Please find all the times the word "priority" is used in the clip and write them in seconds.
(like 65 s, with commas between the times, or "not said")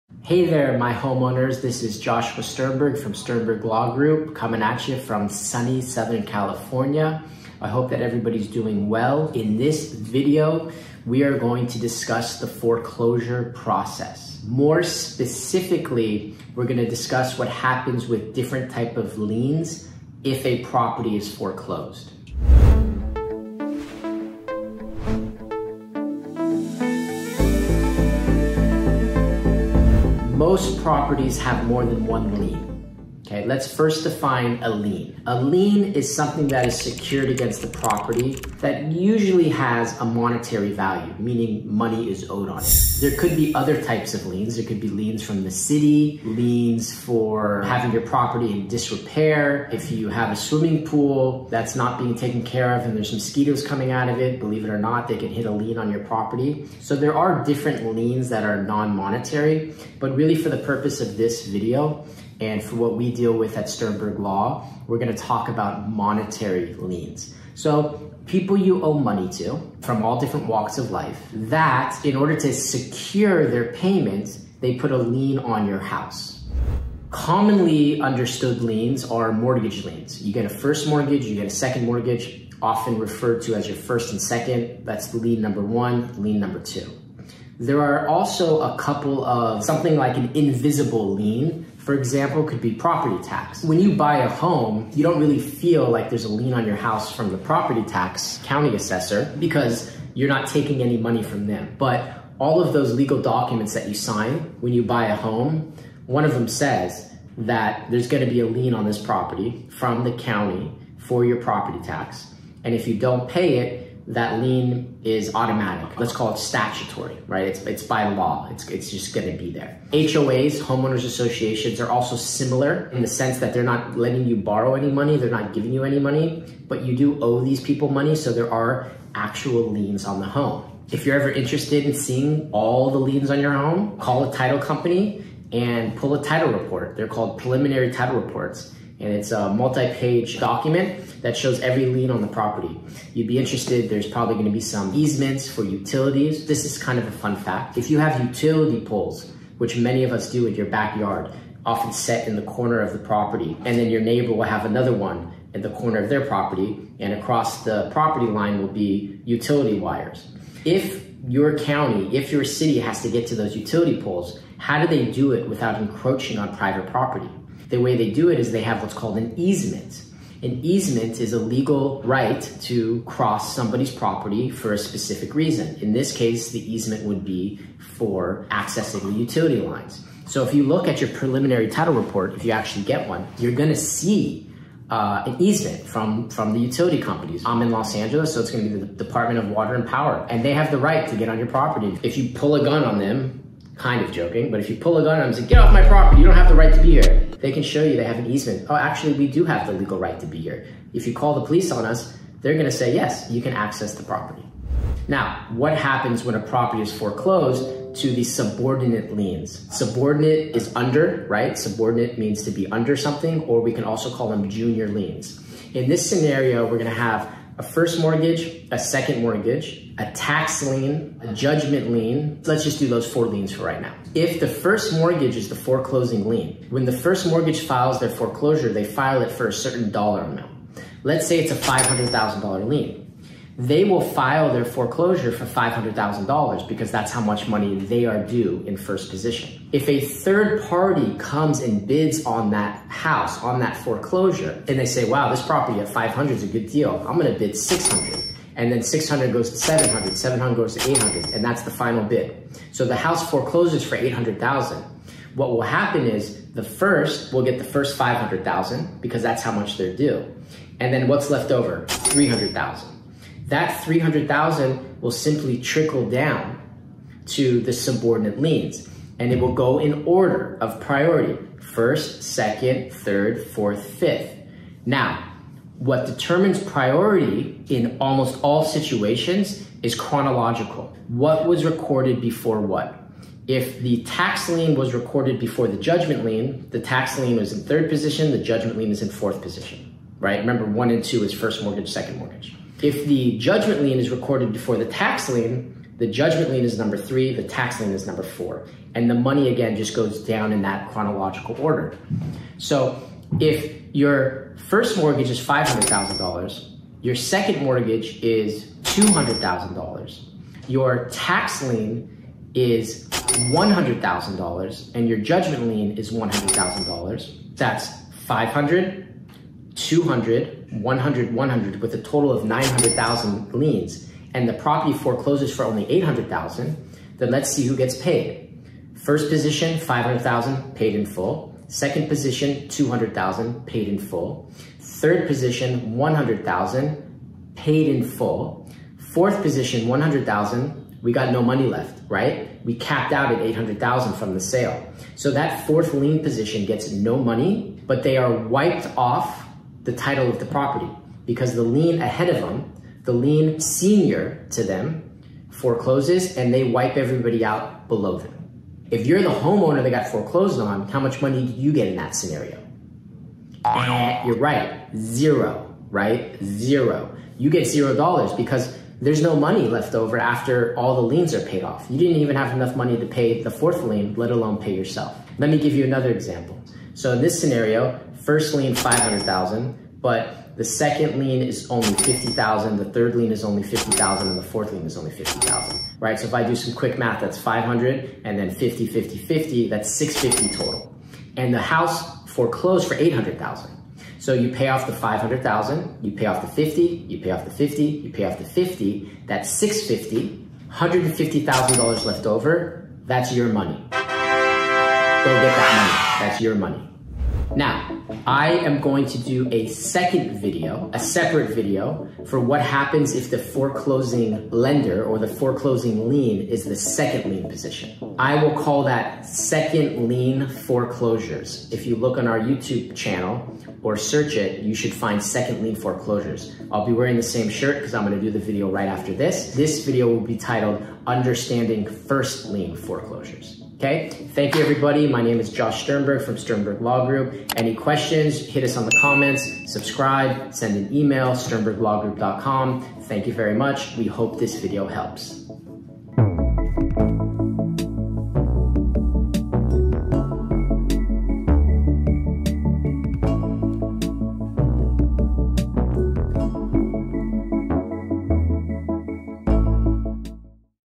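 270 s, 276 s.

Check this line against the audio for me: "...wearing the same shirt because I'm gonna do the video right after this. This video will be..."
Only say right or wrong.
right.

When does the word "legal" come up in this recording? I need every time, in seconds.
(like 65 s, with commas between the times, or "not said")
102 s, 171 s, 199 s.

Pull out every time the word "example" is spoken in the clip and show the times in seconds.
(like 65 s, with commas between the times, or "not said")
91 s, 376 s.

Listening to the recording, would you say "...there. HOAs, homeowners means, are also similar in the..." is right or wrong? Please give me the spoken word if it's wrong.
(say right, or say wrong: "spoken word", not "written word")
wrong: "associations", not "means".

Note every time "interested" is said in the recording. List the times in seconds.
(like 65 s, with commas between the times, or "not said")
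131 s, 143 s.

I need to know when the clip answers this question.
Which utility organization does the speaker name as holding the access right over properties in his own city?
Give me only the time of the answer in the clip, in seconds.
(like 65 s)
188 s.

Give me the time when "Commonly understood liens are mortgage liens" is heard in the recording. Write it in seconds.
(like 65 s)
77 s.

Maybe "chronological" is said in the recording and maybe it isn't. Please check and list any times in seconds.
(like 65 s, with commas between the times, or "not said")
279 s, 300 s.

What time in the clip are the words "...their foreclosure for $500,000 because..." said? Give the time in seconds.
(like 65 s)
234 s.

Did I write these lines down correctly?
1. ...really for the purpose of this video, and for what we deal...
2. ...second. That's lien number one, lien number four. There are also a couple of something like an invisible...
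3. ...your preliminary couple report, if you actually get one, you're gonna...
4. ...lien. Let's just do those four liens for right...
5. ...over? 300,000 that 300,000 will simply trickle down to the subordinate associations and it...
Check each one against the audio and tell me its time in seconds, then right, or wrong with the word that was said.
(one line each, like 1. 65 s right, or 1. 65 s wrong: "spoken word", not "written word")
1. 60 s right
2. 84 s wrong: "two", not "four"
3. 180 s wrong: "title", not "couple"
4. 221 s right
5. 261 s wrong: "liens", not "associations".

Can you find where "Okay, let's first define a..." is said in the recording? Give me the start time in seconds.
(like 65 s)
33 s.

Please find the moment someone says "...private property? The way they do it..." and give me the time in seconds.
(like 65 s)
166 s.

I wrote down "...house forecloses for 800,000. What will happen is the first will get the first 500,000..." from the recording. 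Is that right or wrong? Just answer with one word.
right.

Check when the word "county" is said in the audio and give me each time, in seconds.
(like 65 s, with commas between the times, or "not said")
98 s, 110 s, 161 s.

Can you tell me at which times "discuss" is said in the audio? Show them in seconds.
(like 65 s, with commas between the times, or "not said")
11 s, 16 s.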